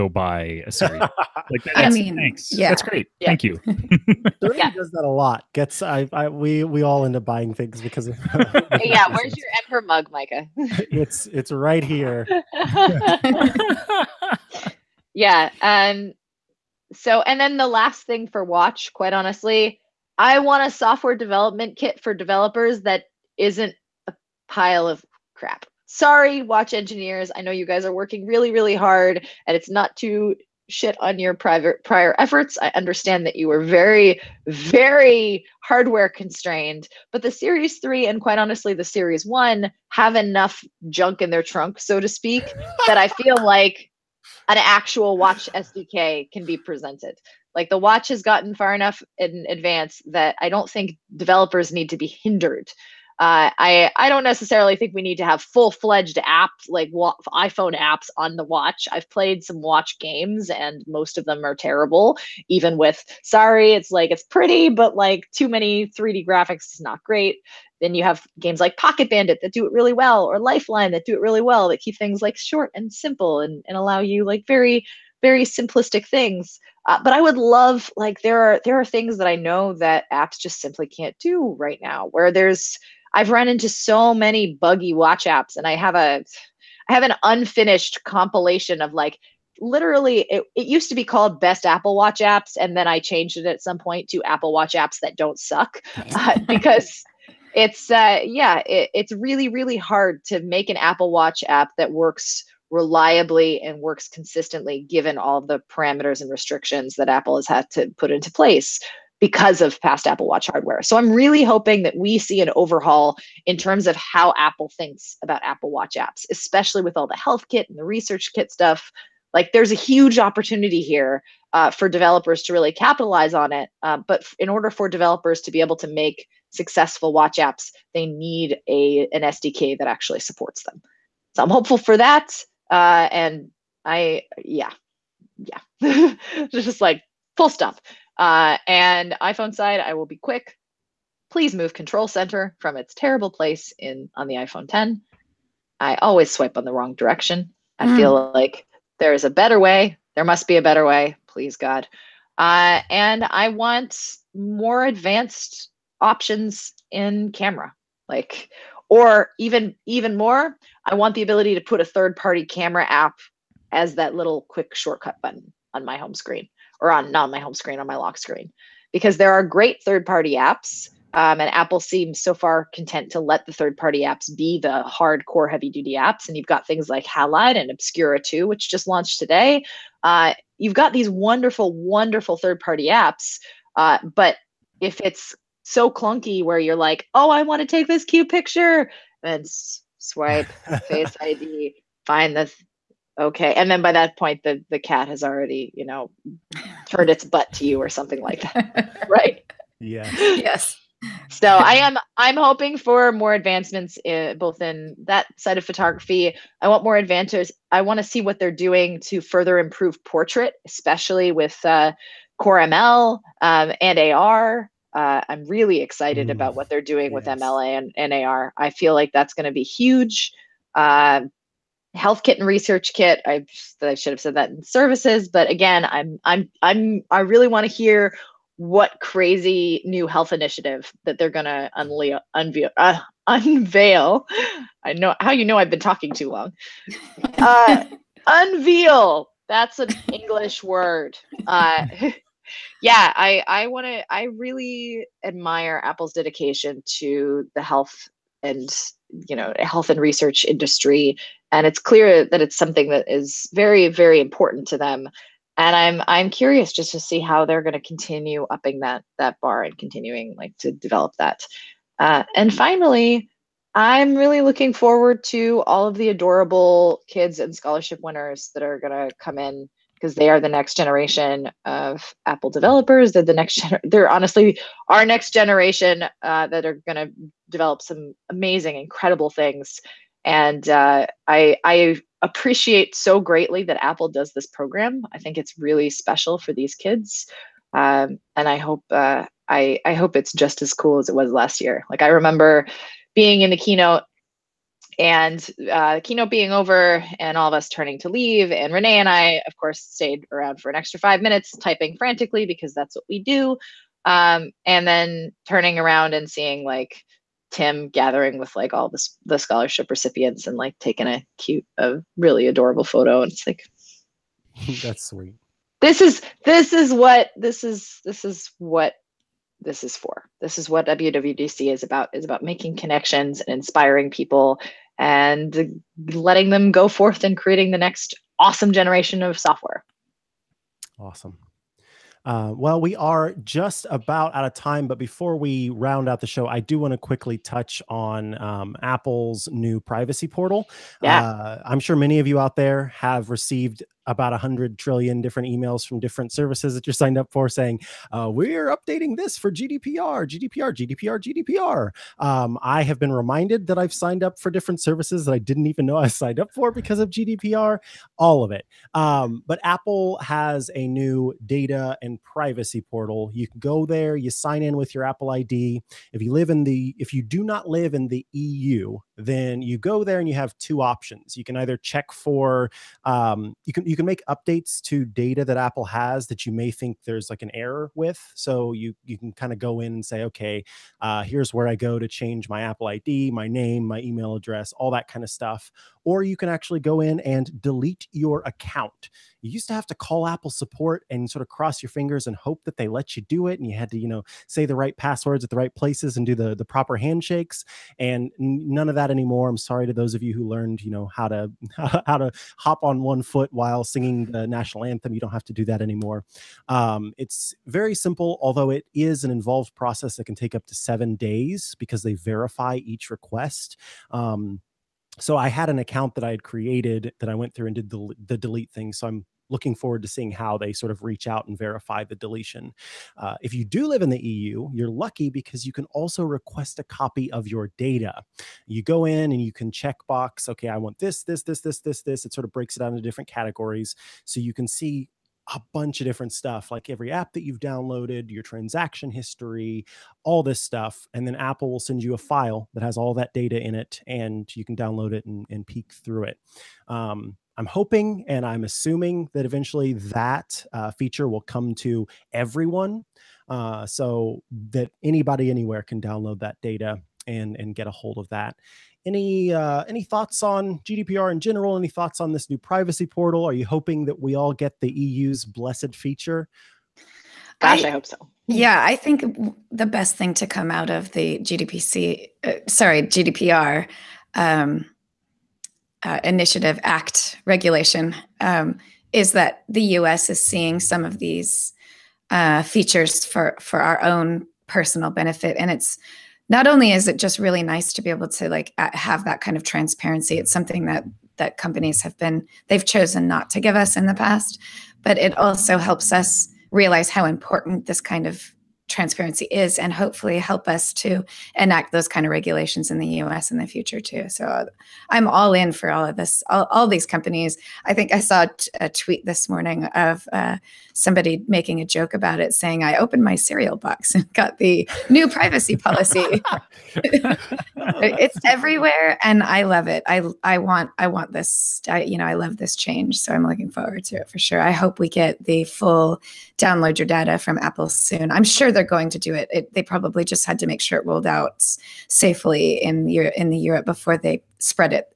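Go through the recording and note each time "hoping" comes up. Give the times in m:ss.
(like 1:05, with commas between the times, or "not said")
1:51, 3:22, 7:27, 7:43.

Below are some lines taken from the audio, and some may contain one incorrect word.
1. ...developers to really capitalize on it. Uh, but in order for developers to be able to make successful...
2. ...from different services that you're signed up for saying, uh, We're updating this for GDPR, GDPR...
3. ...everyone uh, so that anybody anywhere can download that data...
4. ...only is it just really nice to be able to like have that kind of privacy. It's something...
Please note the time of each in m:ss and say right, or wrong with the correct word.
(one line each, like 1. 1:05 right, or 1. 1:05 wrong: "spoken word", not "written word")
1. 2:01 right
2. 5:45 right
3. 7:32 right
4. 8:06 wrong: "transparency", not "privacy".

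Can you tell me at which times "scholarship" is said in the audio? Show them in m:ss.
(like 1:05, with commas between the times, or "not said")
4:27, 5:09.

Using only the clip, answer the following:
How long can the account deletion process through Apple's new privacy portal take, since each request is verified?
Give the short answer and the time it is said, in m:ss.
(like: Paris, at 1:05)
7 days, at 6:50.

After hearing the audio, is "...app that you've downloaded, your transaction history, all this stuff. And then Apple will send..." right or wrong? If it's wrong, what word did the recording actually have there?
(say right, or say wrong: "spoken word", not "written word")
right.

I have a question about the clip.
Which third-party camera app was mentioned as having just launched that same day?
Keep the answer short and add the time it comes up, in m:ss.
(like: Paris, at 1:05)
Obscura 2, at 2:57.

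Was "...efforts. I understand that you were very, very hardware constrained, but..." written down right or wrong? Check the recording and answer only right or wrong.
right.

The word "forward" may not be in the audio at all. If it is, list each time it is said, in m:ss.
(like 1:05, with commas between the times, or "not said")
4:24, 6:59, 8:43.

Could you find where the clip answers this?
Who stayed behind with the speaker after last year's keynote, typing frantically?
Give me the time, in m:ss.
4:58.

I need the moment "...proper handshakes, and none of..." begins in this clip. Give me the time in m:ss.
6:36.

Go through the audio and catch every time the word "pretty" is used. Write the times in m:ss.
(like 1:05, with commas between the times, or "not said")
1:04.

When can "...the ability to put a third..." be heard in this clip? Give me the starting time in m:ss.
2:41.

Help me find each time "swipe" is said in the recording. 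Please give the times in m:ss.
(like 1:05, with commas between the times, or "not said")
2:26, 3:09.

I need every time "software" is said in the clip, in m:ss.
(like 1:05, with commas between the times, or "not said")
0:20, 5:29.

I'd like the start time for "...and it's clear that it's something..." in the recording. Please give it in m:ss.
4:11.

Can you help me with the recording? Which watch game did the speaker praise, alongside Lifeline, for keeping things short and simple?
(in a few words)
Pocket Bandit.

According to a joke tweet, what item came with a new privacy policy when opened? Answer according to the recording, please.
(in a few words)
cereal box.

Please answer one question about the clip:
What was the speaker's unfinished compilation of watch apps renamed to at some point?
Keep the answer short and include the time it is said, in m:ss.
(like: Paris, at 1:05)
Apple Watch apps that don't suck, at 1:34.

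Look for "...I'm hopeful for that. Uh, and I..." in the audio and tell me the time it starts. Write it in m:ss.
2:11.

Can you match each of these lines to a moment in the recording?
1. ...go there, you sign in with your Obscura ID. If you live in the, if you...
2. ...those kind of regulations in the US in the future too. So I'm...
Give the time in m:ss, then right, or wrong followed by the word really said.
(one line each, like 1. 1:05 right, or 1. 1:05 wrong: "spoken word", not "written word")
1. 6:03 wrong: "Apple", not "Obscura"
2. 8:21 right.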